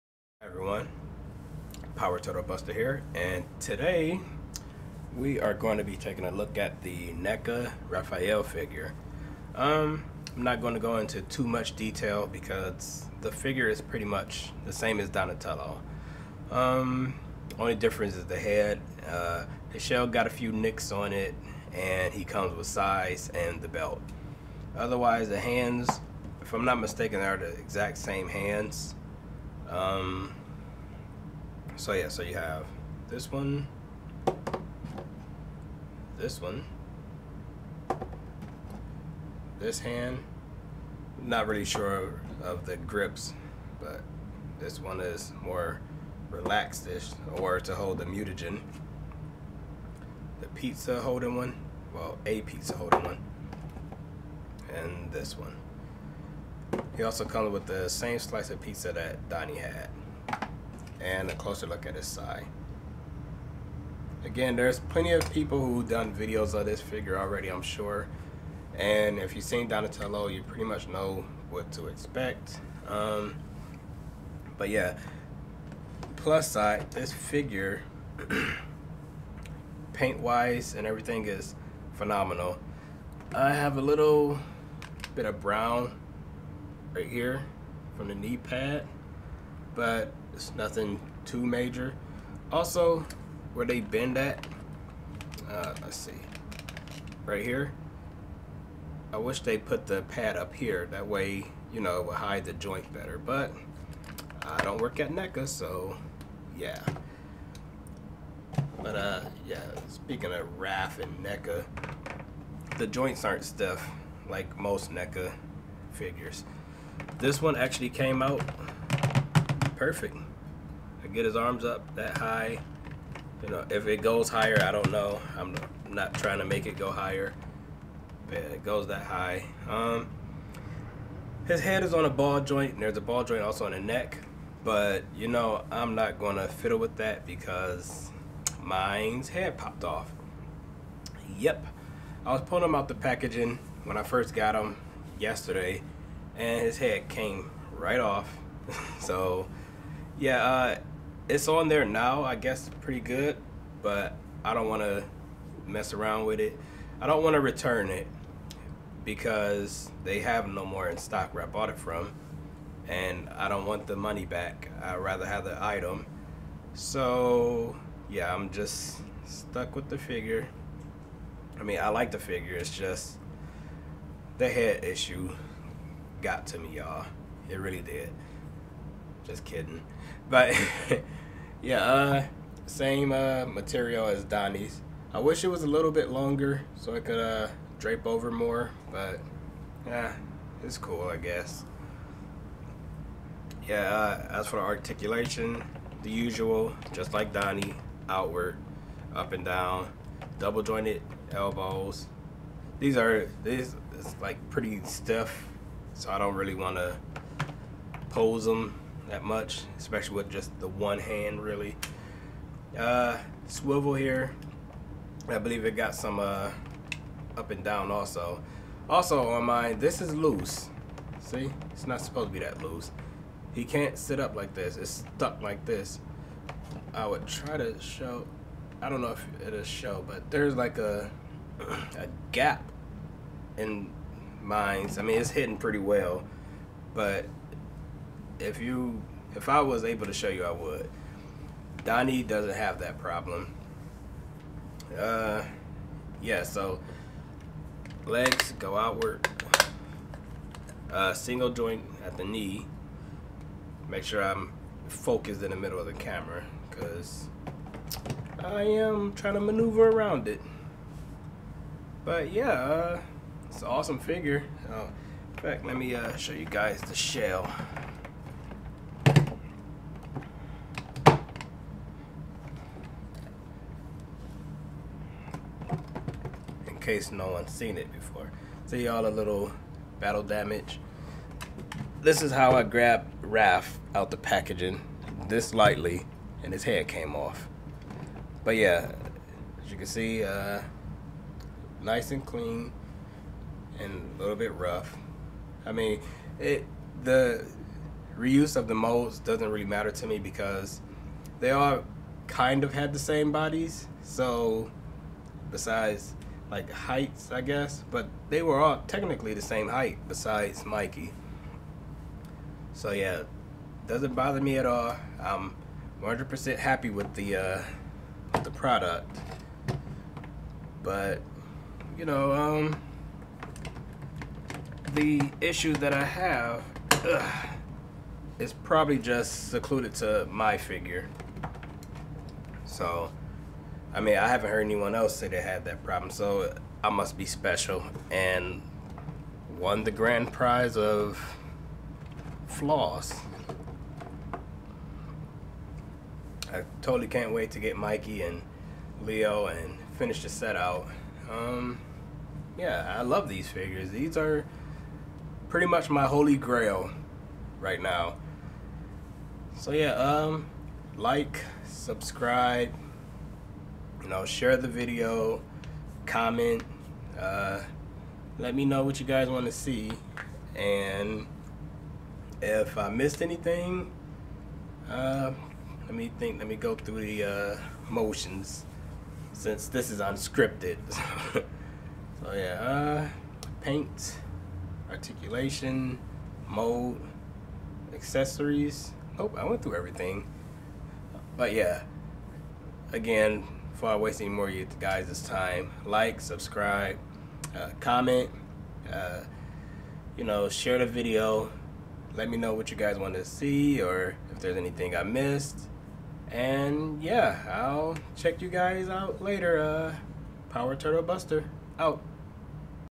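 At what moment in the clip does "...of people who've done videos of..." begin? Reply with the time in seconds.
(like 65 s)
65 s.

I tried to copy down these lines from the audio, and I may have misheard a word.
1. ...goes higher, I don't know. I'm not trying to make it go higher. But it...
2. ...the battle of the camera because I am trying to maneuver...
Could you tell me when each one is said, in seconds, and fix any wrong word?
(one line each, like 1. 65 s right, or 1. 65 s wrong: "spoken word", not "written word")
1. 124 s right
2. 255 s wrong: "middle", not "battle".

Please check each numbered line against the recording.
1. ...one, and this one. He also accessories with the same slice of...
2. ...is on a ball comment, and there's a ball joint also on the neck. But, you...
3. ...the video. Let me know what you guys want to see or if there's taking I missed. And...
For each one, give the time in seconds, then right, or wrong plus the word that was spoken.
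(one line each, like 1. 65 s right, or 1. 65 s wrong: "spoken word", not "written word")
1. 53 s wrong: "comes", not "accessories"
2. 131 s wrong: "joint", not "comment"
3. 400 s wrong: "anything", not "taking".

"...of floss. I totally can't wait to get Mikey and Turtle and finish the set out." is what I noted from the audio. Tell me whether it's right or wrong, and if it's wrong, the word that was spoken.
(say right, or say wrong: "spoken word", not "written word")
wrong: "Leo", not "Turtle".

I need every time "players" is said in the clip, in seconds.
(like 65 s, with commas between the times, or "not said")
not said.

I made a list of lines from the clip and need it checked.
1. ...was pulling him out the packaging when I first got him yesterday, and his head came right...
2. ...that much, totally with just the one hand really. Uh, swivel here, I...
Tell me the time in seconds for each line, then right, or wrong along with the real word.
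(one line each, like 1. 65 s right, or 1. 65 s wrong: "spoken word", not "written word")
1. 142 s right
2. 209 s wrong: "especially", not "totally".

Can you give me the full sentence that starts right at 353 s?
These are pretty much my holy grail right now.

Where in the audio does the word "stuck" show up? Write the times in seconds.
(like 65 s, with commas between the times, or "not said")
169 s, 225 s.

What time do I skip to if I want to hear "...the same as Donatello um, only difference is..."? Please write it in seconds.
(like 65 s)
14 s.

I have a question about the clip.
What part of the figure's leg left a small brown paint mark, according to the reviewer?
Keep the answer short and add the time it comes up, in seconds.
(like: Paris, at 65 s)
Knee pad, at 88 s.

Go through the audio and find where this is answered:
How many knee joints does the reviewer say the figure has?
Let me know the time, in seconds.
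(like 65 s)
251 s.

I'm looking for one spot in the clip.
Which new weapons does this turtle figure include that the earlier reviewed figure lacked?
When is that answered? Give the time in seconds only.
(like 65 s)
22 s.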